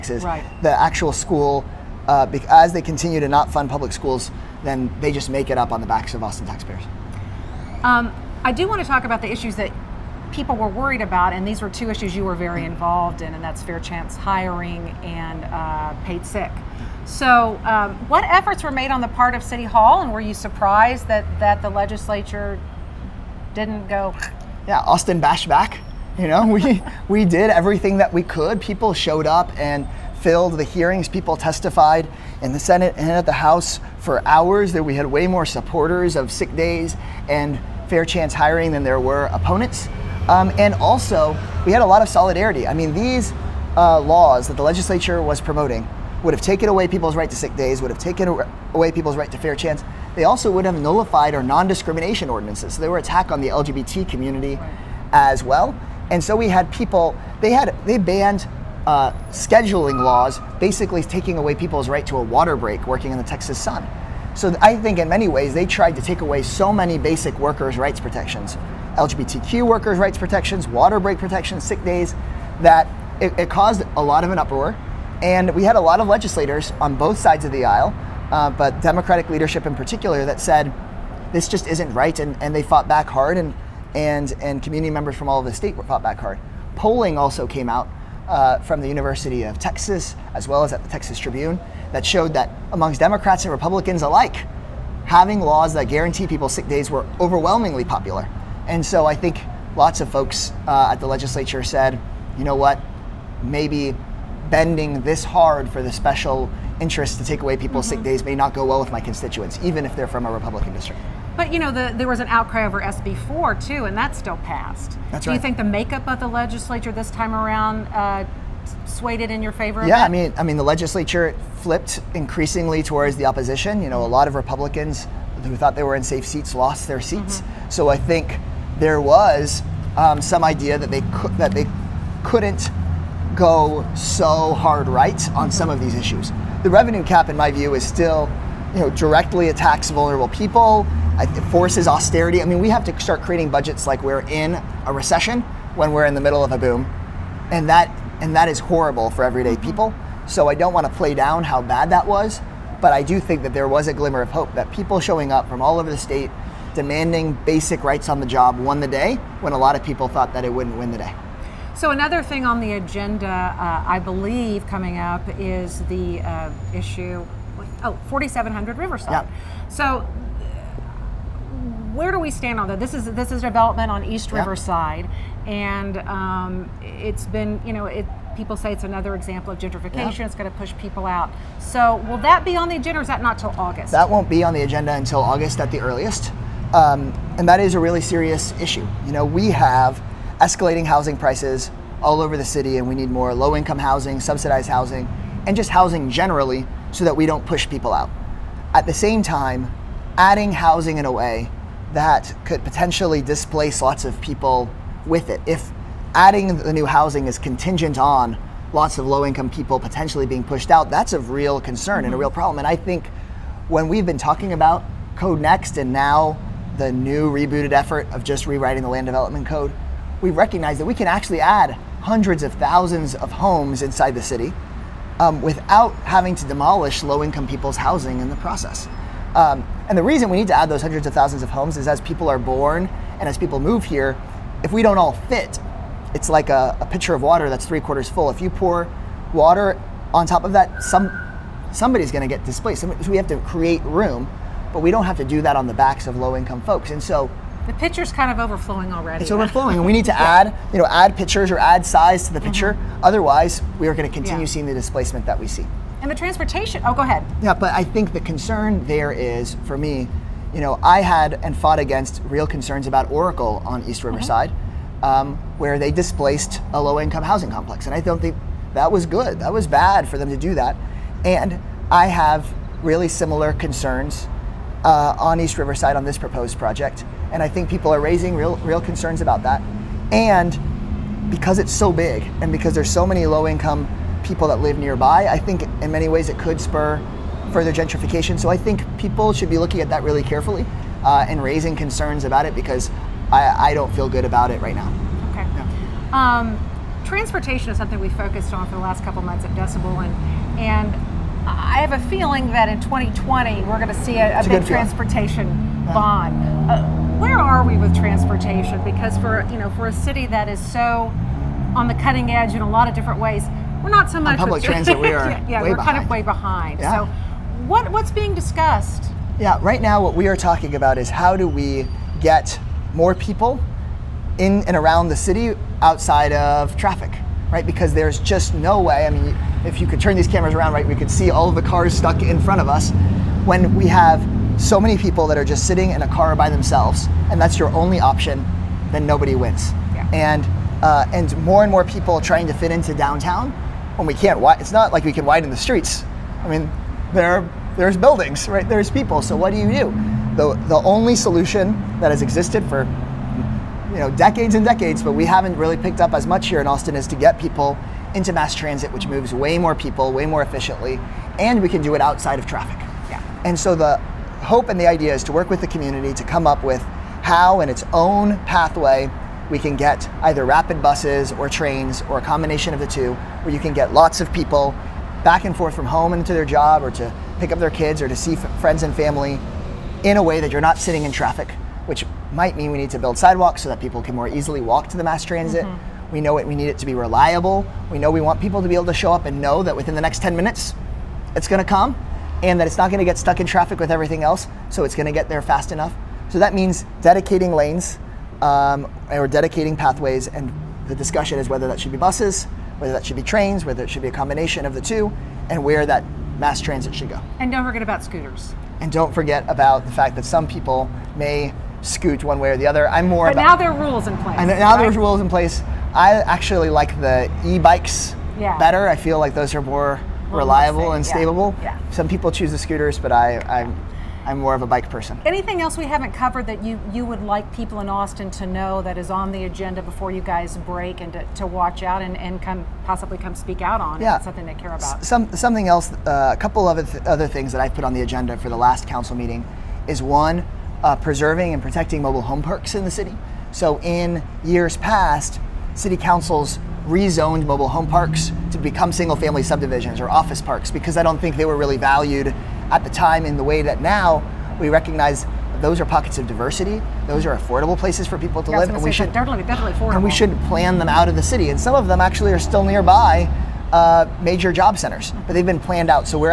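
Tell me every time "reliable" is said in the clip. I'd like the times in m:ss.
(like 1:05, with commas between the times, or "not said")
6:26, 7:00.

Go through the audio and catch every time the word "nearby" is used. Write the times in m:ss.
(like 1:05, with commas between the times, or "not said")
4:44, 7:42.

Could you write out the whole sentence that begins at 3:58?
If you pour water on top of that, some somebody's going to get displaced.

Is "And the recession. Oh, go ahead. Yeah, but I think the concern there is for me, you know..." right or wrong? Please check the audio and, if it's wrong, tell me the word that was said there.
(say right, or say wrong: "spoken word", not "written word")
wrong: "transportation", not "recession".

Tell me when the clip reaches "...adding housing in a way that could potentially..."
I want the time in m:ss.
3:20.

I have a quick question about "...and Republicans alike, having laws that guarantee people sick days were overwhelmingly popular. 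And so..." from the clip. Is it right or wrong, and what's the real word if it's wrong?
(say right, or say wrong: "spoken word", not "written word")
right.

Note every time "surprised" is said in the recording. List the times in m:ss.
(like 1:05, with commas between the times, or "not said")
0:20.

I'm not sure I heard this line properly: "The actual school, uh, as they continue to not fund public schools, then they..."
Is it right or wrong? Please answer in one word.
right.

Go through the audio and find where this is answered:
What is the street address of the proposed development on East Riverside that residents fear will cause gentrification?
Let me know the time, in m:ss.
2:48.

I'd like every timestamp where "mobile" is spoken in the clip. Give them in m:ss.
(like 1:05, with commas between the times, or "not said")
7:22, 7:27.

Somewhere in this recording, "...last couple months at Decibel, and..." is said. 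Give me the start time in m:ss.
4:58.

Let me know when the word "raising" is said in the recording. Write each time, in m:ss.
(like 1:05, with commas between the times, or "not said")
4:38, 4:51.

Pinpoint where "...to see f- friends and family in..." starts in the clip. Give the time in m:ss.
6:18.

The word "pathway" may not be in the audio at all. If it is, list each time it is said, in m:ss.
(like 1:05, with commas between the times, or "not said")
6:08, 6:39.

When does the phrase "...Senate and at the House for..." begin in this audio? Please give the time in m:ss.
0:32.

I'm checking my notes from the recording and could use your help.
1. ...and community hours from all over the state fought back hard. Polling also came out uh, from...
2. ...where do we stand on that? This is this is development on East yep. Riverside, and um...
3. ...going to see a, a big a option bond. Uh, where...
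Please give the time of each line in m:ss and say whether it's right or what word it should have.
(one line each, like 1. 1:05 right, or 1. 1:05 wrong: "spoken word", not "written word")
1. 1:24 wrong: "members", not "hours"
2. 2:51 right
3. 5:03 wrong: "transportation", not "option".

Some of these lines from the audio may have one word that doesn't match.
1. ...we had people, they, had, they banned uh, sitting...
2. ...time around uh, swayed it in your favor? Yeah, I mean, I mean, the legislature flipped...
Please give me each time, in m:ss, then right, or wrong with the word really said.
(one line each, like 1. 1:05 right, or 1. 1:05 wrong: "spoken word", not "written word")
1. 0:56 wrong: "scheduling", not "sitting"
2. 1:57 right.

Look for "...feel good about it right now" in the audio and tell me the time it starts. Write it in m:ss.
4:53.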